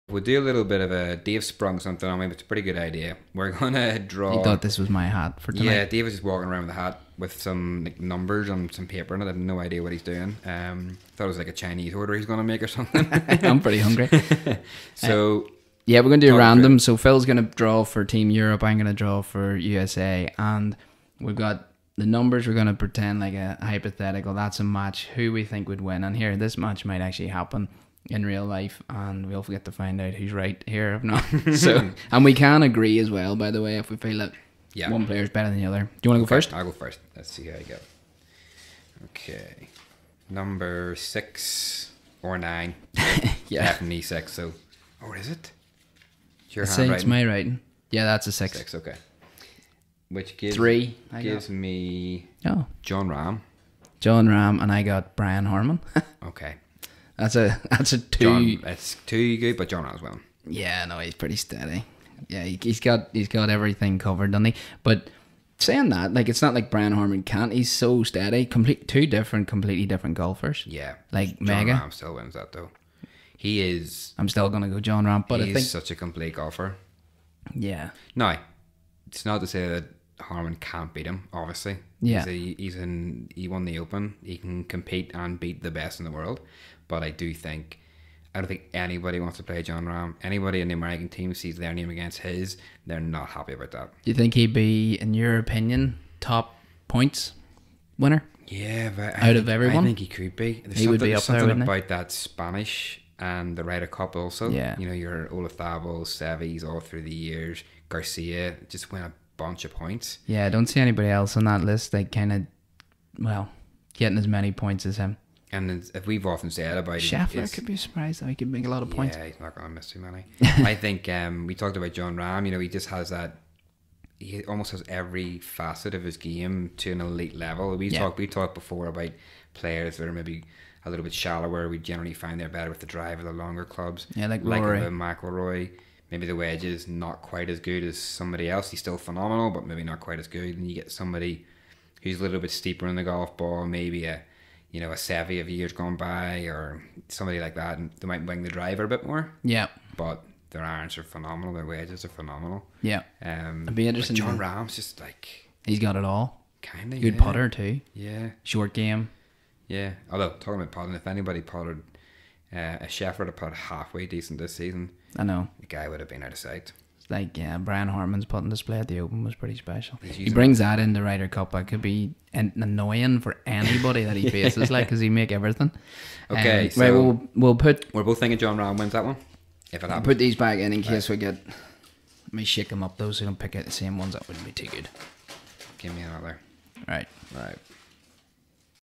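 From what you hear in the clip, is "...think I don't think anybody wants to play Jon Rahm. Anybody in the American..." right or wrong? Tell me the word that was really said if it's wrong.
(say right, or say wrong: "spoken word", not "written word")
right.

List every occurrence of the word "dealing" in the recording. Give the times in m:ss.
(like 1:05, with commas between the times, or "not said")
not said.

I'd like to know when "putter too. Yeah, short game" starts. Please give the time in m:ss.
2:37.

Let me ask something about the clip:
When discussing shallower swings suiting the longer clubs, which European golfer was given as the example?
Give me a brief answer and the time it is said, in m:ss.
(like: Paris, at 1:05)
Rory McIlroy, at 2:14.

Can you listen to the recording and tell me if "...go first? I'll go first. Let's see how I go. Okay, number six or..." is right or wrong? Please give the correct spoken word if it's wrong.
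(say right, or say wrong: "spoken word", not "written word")
right.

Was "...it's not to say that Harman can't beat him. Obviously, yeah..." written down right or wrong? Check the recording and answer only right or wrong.
right.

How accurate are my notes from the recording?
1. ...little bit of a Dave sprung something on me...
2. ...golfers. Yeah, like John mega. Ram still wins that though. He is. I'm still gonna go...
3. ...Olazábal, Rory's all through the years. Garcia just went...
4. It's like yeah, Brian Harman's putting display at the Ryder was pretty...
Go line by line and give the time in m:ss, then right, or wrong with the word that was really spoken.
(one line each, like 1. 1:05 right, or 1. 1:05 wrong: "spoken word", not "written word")
1. 0:00 right
2. 1:10 right
3. 1:45 wrong: "Seve", not "Rory"
4. 2:46 wrong: "Open", not "Ryder".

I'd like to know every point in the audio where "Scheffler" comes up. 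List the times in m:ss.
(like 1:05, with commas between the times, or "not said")
1:56, 2:42.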